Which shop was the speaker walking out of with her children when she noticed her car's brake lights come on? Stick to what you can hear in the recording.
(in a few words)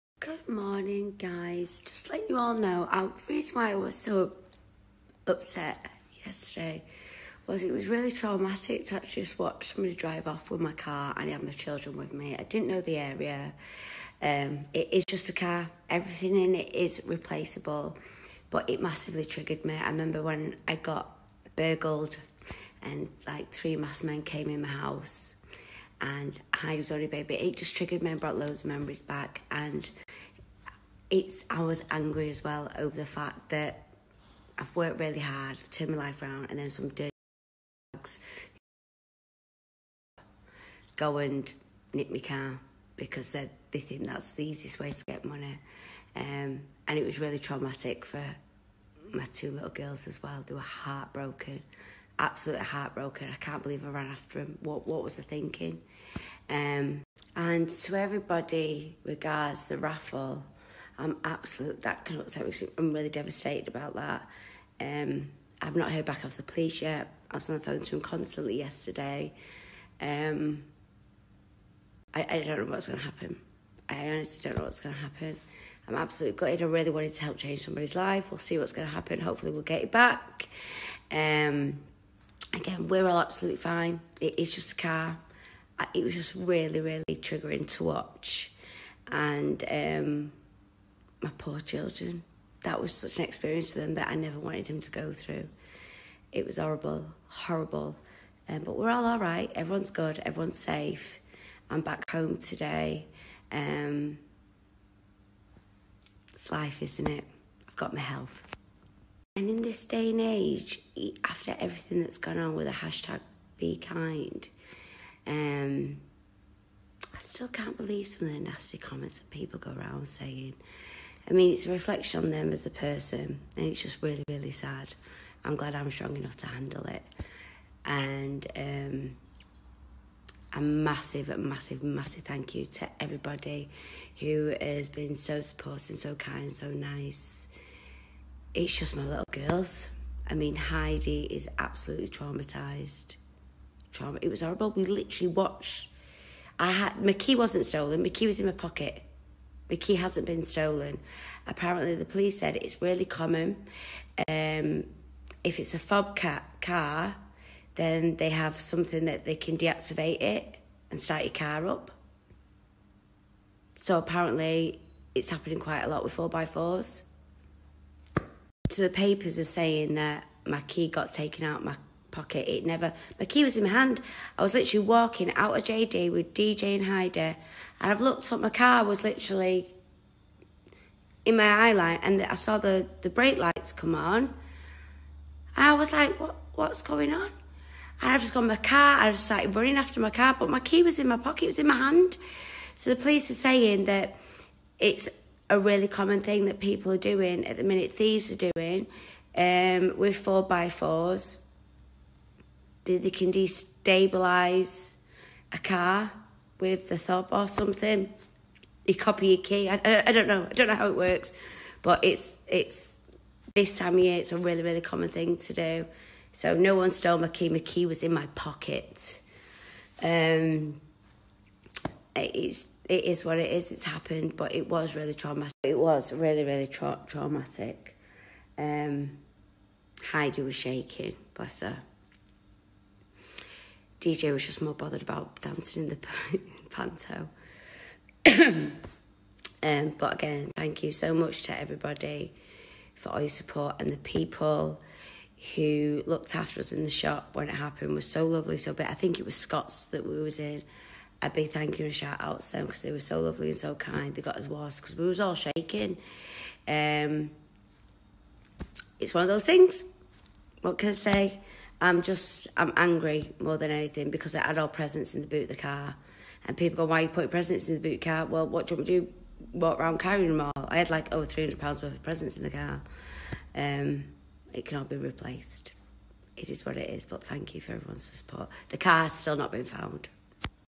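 JD.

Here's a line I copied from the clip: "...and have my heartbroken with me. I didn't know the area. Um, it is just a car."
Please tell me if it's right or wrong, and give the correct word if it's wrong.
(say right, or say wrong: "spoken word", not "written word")
wrong: "children", not "heartbroken".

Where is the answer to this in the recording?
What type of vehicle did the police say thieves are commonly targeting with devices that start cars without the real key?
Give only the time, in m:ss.
2:46.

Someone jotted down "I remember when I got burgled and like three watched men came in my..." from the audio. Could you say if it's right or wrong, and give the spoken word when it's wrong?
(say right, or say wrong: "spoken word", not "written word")
wrong: "masked", not "watched".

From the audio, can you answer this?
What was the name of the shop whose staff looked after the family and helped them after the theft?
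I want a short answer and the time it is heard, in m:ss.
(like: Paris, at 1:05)
Scott's, at 4:09.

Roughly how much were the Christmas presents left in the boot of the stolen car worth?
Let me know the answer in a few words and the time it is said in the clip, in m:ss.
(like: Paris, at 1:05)
over £300, at 4:31.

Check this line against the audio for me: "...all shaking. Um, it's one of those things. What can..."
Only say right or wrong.
right.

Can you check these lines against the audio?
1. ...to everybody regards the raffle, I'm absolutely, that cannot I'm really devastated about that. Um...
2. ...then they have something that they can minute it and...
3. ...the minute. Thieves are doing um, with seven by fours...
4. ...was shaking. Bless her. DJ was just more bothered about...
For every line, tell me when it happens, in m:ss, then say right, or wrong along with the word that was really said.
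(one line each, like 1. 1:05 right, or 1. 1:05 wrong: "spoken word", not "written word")
1. 0:57 right
2. 2:37 wrong: "deactivate", not "minute"
3. 3:17 wrong: "four", not "seven"
4. 3:50 right.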